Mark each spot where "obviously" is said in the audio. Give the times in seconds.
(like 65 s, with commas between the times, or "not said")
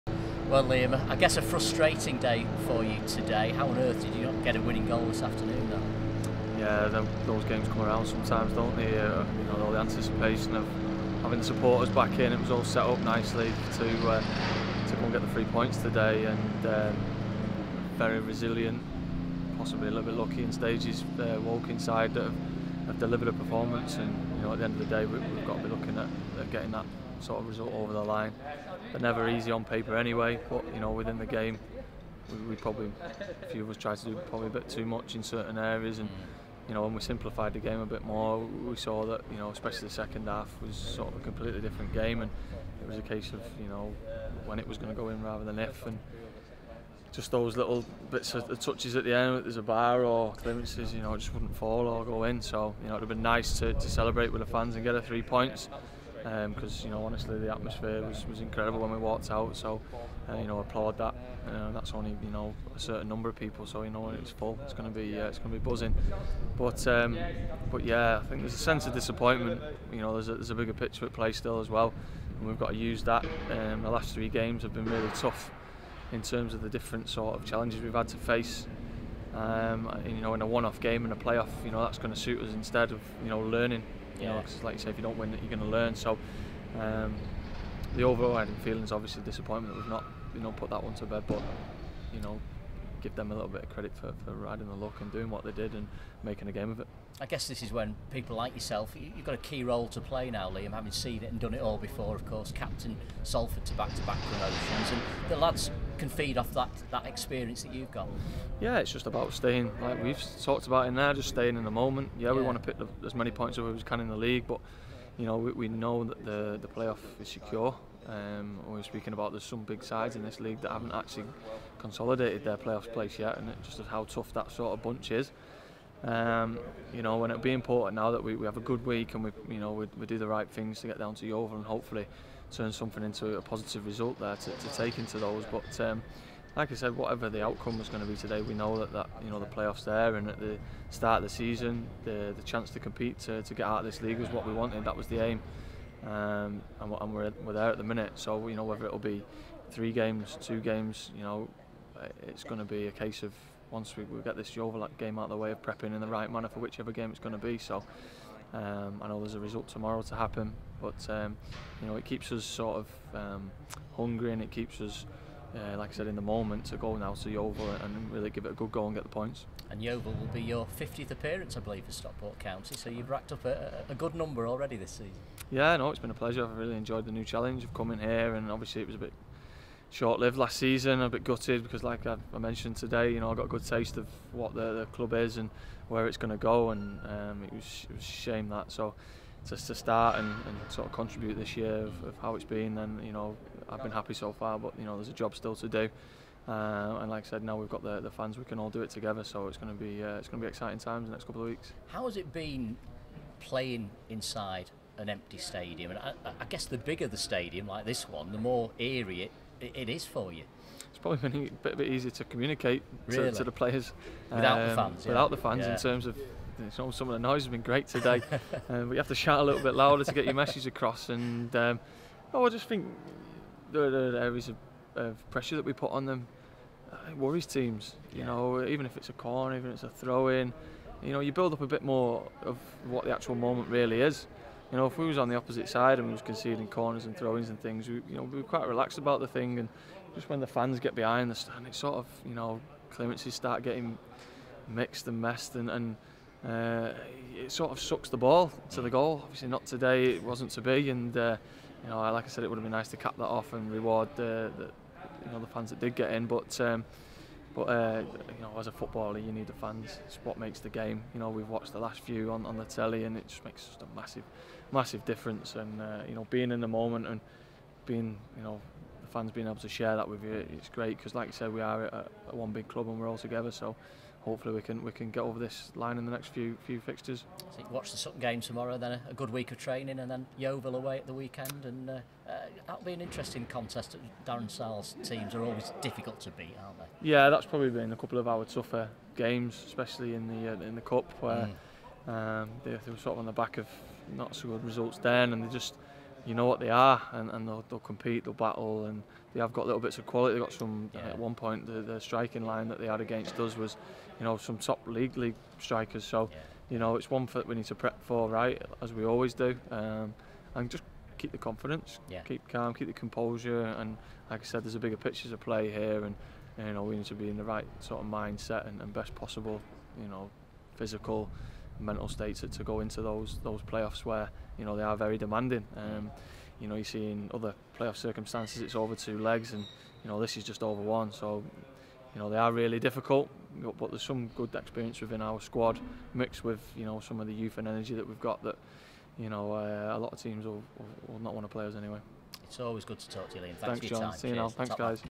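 88 s, 178 s, 249 s.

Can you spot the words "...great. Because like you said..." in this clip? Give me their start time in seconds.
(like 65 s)
270 s.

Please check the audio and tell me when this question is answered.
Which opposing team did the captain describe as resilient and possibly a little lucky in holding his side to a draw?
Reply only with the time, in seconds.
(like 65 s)
21 s.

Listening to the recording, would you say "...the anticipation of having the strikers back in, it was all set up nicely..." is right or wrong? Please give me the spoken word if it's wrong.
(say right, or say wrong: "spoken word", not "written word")
wrong: "supporters", not "strikers".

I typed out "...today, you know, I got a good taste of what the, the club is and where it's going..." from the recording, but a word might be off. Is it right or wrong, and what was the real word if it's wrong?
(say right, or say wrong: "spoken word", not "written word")
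right.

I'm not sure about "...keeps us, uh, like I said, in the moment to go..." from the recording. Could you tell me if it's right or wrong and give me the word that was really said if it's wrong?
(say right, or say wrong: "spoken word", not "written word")
right.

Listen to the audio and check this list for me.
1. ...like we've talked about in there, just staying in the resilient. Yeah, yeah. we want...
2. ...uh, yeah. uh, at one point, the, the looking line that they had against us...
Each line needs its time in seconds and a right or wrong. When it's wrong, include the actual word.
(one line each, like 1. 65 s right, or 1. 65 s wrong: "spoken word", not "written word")
1. 109 s wrong: "moment", not "resilient"
2. 300 s wrong: "striking", not "looking".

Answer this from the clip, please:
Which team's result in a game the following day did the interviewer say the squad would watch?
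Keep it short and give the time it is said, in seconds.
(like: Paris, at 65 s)
Sutton, at 277 s.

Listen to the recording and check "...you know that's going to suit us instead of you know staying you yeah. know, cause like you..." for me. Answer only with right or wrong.
wrong.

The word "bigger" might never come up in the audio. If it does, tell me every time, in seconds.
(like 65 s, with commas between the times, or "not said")
70 s, 206 s, 314 s.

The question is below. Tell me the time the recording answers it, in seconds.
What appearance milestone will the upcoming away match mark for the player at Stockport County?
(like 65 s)
170 s.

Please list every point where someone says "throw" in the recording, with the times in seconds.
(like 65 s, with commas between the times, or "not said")
229 s, 237 s.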